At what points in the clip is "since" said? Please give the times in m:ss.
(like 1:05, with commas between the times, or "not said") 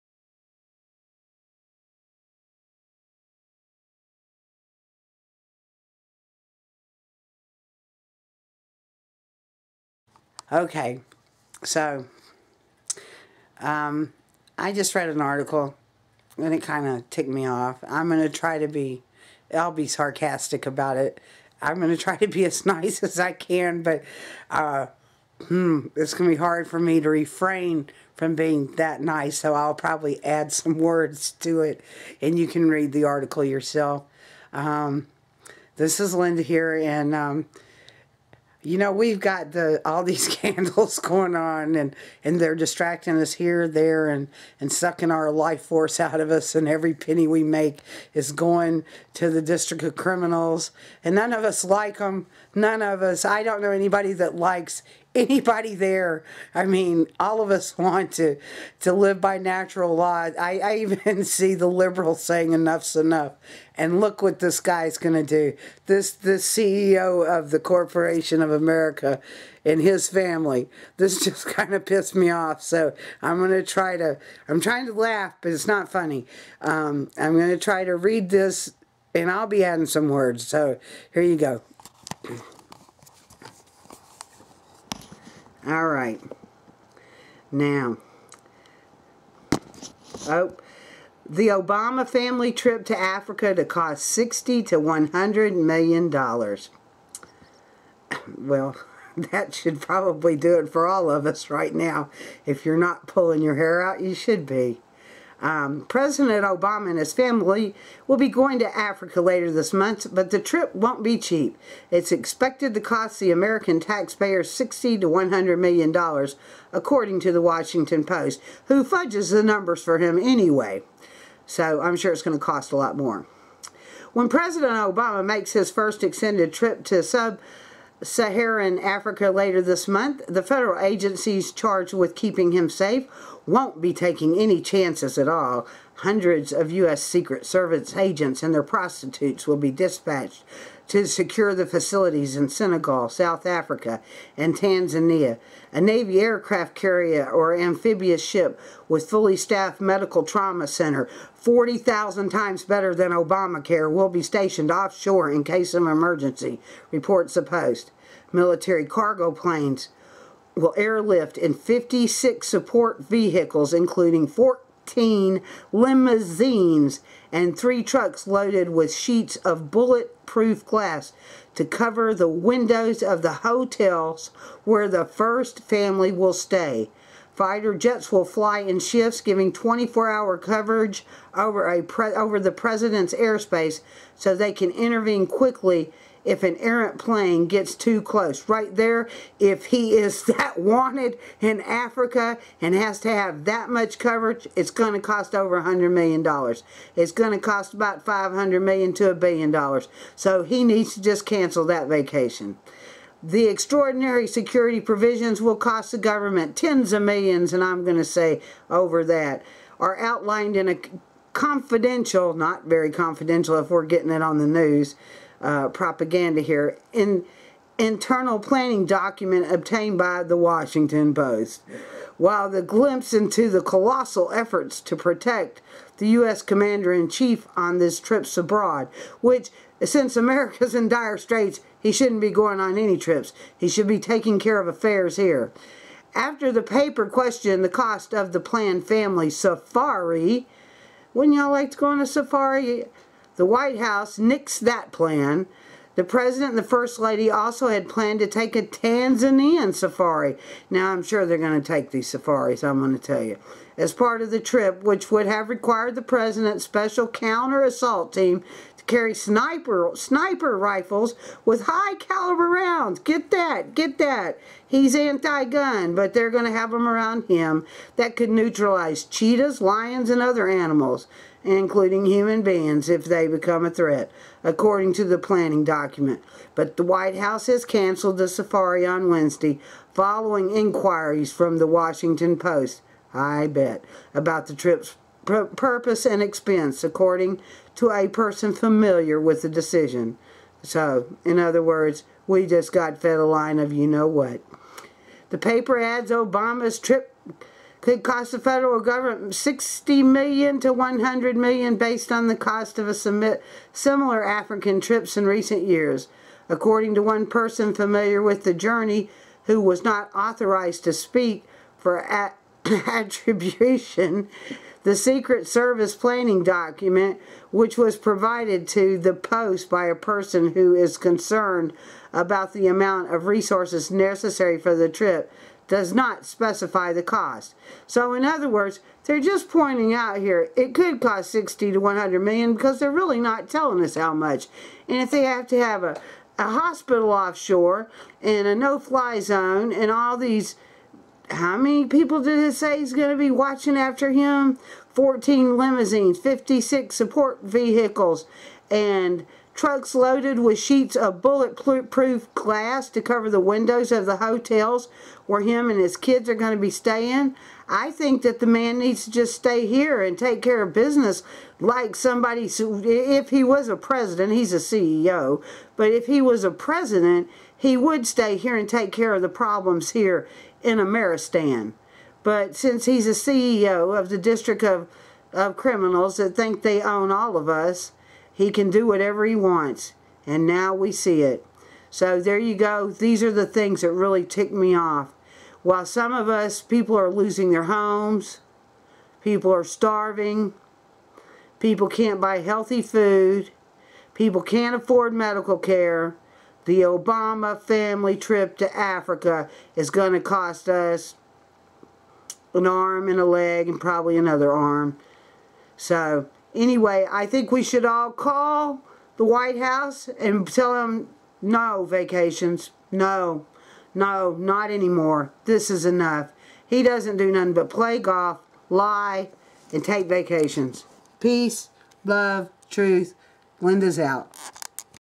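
3:49, 6:12.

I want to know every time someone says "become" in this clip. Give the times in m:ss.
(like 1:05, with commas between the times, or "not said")
4:33.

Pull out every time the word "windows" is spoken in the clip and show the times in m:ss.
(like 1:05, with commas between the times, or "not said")
2:52, 5:53.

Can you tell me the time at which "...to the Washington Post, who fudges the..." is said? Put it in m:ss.
1:57.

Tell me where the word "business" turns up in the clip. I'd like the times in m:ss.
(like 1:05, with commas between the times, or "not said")
6:00.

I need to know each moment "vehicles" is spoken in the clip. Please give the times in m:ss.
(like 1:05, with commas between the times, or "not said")
2:43, 5:47.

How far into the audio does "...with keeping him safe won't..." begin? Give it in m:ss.
2:11.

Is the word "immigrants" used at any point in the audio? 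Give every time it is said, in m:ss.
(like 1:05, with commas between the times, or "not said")
not said.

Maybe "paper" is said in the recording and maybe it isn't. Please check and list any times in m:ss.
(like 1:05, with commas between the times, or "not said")
3:56, 4:55.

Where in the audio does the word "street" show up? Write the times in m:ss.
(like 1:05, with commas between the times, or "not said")
not said.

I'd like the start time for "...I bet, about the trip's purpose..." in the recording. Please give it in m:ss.
4:43.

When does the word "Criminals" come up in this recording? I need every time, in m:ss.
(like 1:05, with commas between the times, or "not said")
0:49, 6:15.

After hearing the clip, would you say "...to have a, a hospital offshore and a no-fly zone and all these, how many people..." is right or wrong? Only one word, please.
right.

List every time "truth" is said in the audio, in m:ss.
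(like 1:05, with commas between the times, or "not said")
7:02.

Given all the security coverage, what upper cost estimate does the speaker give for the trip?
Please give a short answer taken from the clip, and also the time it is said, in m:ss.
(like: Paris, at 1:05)
1 billion dollars, at 3:19.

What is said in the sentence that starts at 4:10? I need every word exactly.
Now, I'm sure they're going to take these safaris, I'm going to tell you.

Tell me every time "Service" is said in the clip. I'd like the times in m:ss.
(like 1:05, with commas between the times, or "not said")
2:17, 5:15.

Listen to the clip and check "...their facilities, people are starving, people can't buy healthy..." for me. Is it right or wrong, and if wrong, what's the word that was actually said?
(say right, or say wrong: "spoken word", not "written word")
wrong: "homes", not "facilities".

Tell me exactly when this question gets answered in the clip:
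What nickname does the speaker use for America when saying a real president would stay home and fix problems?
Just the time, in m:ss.
6:10.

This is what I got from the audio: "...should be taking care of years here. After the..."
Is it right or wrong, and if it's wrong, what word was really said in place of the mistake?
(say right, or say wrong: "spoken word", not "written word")
wrong: "affairs", not "years".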